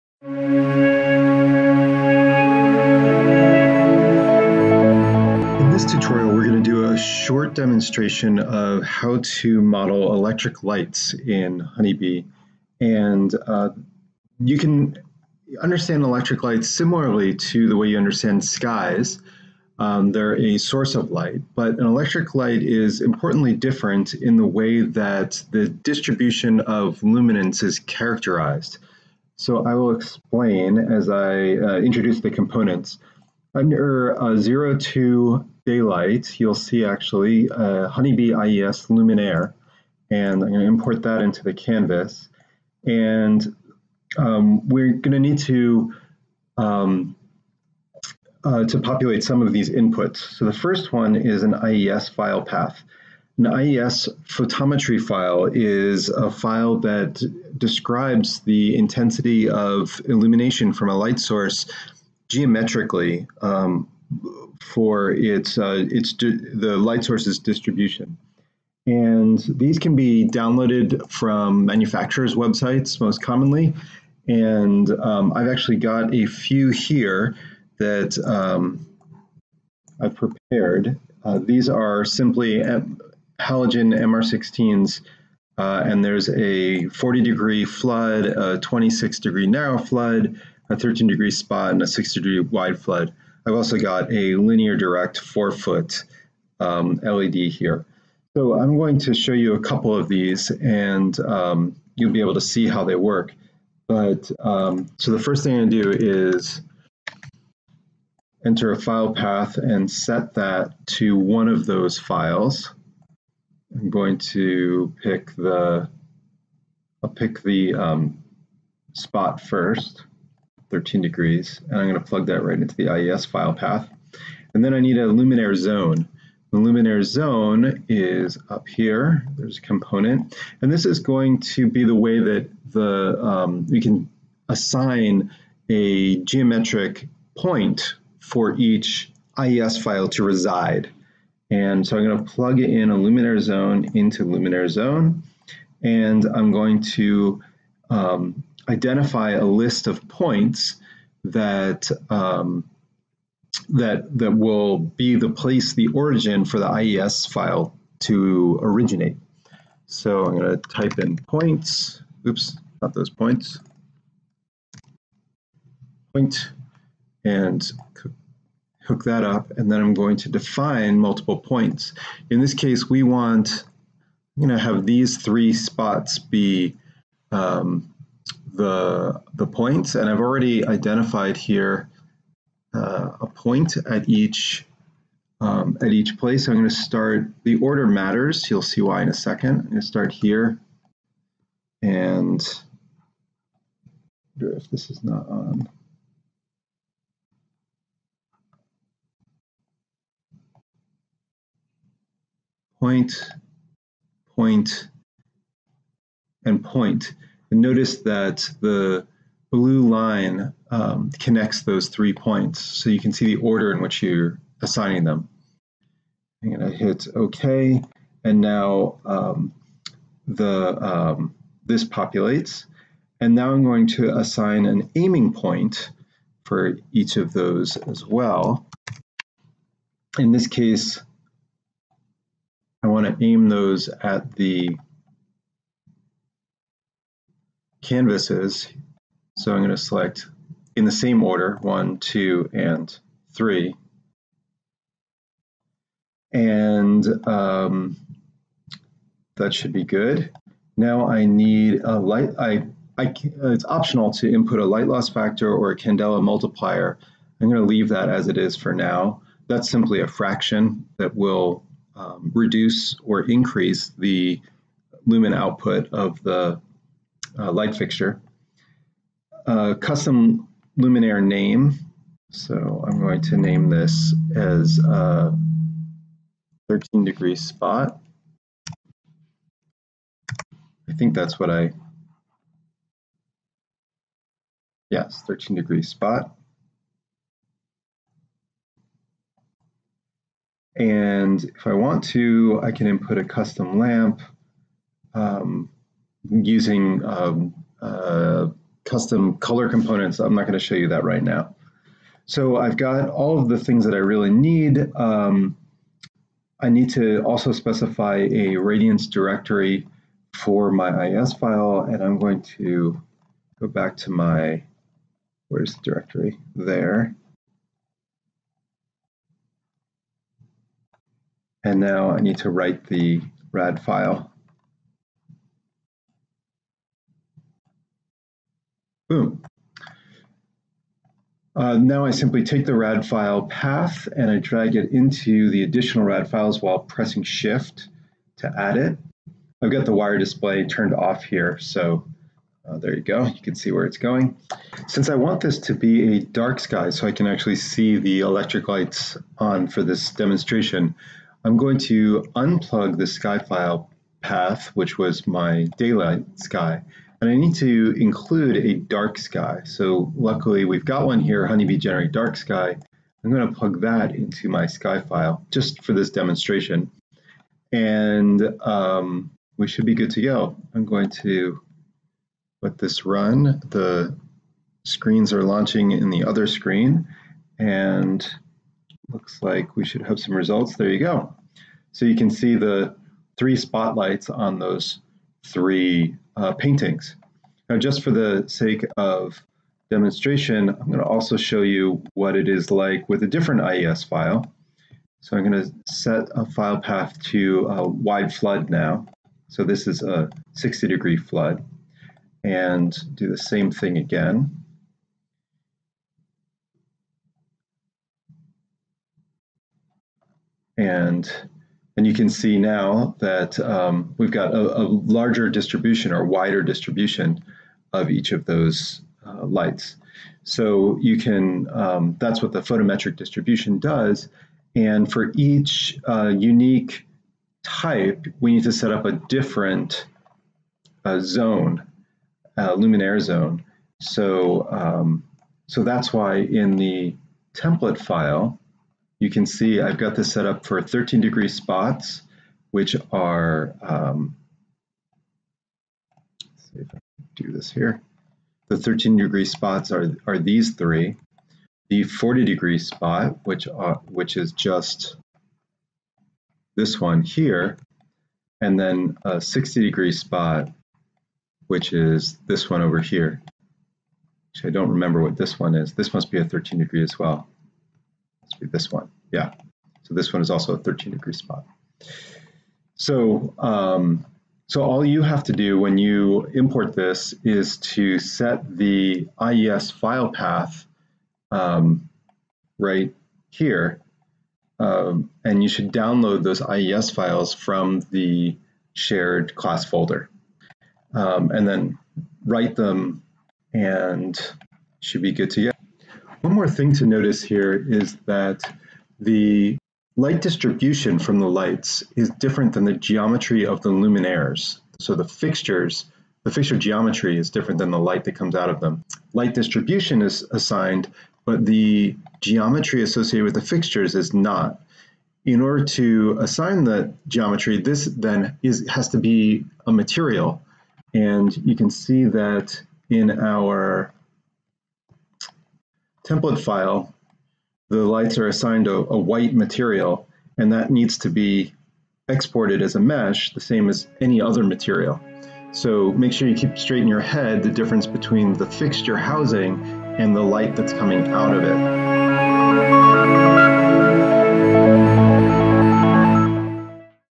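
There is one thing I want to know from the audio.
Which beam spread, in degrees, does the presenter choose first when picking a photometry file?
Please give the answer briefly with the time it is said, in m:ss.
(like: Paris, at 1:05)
13, at 2:00.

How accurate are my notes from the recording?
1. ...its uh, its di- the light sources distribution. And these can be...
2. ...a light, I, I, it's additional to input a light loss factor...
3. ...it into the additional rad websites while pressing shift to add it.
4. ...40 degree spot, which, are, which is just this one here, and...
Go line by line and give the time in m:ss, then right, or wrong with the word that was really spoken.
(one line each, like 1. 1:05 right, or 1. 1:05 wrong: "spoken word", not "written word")
1. 1:05 right
2. 4:11 wrong: "optional", not "additional"
3. 5:34 wrong: "files", not "websites"
4. 7:32 right.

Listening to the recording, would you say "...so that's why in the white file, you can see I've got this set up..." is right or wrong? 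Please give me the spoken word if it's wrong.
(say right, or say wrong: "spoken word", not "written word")
wrong: "template", not "white".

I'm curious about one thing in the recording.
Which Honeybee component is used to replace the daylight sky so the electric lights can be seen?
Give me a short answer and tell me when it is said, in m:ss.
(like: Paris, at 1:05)
Honeybee generate dark sky, at 6:01.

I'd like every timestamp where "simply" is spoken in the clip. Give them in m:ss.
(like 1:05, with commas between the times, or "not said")
1:22, 4:19, 5:32.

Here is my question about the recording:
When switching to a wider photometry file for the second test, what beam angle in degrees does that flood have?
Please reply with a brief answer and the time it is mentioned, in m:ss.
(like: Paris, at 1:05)
60, at 6:40.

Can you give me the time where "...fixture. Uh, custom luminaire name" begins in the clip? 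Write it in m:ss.
4:27.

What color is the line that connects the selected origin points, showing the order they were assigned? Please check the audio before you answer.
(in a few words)
blue.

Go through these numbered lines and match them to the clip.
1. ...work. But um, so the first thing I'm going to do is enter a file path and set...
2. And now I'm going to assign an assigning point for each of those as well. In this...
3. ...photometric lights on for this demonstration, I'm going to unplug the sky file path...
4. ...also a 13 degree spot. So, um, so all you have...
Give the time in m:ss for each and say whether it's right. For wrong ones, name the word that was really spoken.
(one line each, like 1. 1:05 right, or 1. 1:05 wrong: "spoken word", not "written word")
1. 1:42 right
2. 3:43 wrong: "aiming", not "assigning"
3. 5:48 wrong: "electric", not "photometric"
4. 7:50 right.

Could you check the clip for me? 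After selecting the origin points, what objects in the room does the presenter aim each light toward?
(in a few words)
the canvases.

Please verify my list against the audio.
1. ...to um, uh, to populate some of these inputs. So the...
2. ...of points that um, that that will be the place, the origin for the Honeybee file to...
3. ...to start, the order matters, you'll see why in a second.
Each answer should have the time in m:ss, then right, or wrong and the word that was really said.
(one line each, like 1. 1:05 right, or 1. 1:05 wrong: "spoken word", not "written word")
1. 0:45 right
2. 2:29 wrong: "IES", not "Honeybee"
3. 3:06 right.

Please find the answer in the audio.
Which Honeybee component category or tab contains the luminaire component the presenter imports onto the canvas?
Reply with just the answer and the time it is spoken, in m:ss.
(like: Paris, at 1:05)
02 daylight, at 0:34.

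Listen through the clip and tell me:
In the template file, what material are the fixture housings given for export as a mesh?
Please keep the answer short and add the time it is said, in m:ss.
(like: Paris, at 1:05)
white, at 8:49.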